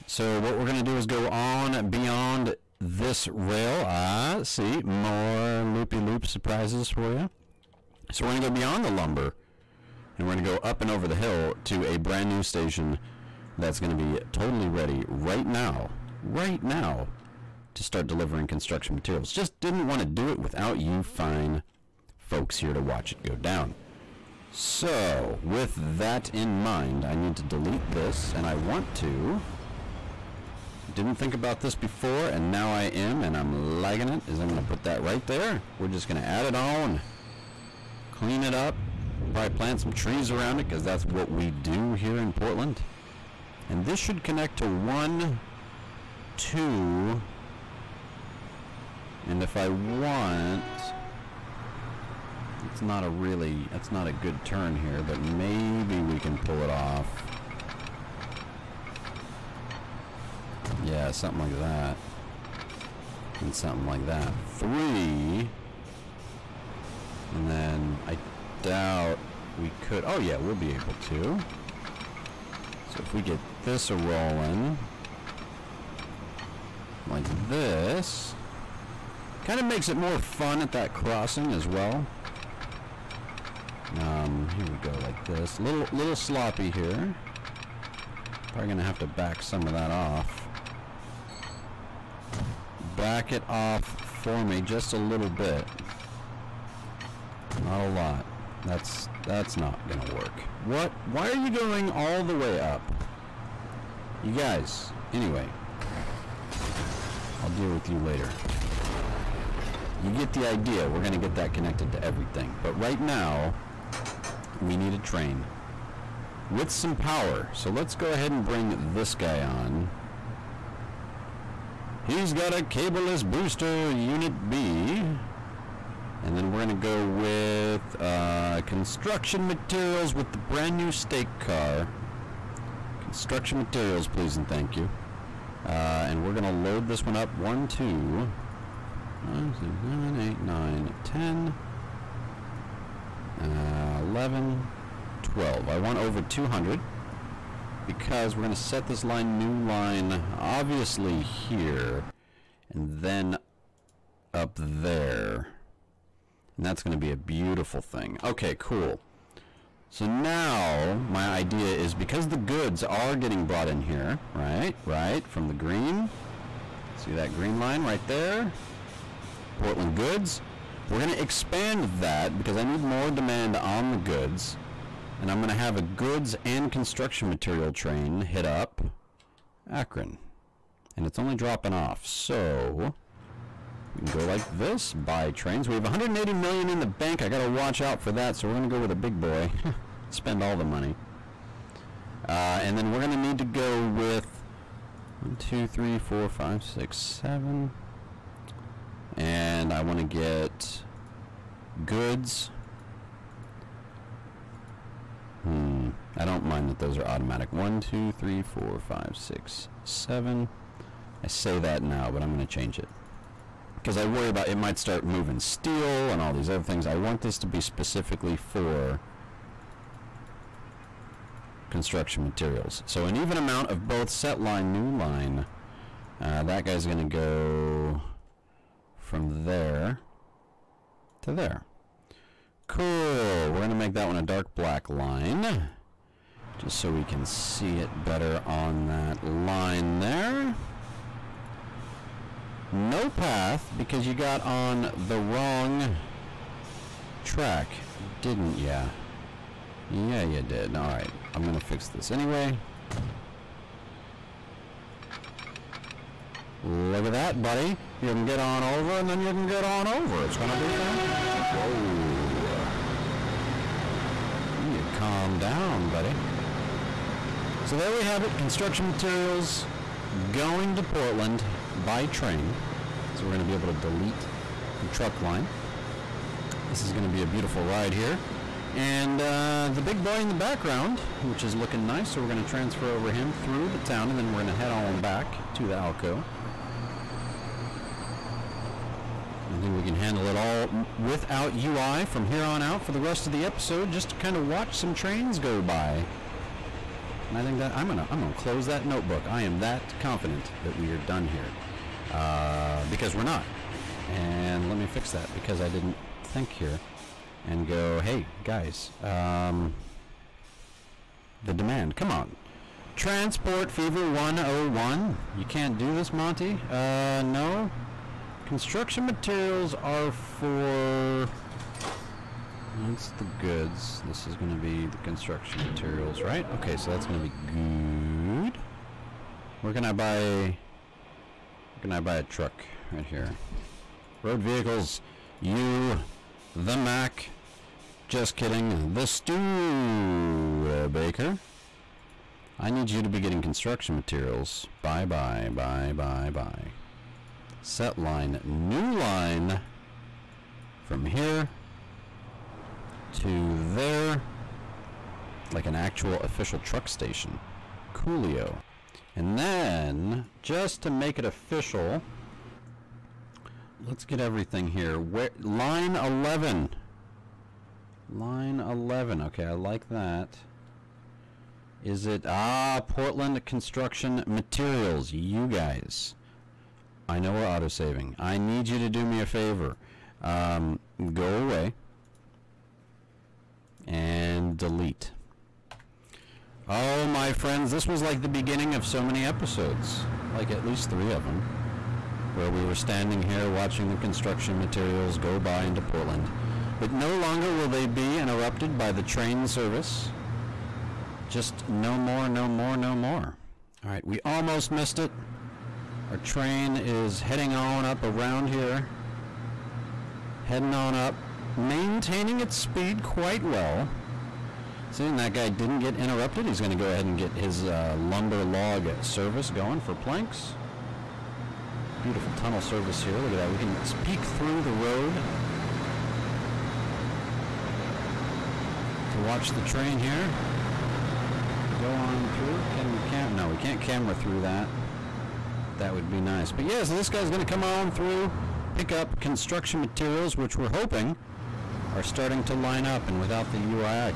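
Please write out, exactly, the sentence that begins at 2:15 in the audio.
Uh, and we're going to load this one up.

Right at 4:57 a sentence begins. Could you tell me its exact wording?
And I think that I'm gonna I'm gonna close that notebook.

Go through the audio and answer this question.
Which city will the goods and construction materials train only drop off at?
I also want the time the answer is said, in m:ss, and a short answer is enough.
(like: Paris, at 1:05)
Akron, at 2:59.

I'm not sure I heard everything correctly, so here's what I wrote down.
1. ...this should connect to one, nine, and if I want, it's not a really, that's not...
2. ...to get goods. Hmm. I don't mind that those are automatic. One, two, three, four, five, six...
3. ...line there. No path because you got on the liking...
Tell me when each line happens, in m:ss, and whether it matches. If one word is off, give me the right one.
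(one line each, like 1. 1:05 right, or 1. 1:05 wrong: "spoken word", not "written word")
1. 0:43 wrong: "two", not "nine"
2. 3:19 right
3. 3:59 wrong: "wrong", not "liking".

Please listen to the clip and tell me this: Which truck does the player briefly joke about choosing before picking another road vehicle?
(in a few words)
the Mack.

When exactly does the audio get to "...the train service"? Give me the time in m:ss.
6:38.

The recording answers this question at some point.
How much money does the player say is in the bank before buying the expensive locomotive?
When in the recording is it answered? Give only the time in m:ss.
3:05.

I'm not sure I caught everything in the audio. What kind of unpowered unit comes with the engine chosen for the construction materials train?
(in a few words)
cabless booster.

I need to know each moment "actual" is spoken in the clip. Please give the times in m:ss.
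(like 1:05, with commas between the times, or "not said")
5:55.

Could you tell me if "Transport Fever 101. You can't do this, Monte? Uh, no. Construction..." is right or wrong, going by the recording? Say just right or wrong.
right.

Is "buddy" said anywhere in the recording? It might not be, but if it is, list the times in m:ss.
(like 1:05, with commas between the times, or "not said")
4:17, 4:25.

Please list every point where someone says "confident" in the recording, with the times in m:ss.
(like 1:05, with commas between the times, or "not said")
5:00.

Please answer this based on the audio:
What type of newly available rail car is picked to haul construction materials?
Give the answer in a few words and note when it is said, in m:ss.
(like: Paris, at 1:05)
stake car, at 2:10.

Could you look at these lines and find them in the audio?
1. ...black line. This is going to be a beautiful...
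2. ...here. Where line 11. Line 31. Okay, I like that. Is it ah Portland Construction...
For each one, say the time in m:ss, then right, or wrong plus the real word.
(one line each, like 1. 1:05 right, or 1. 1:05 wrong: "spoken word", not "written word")
1. 4:34 wrong: "truck", not "black"
2. 6:04 wrong: "11", not "31".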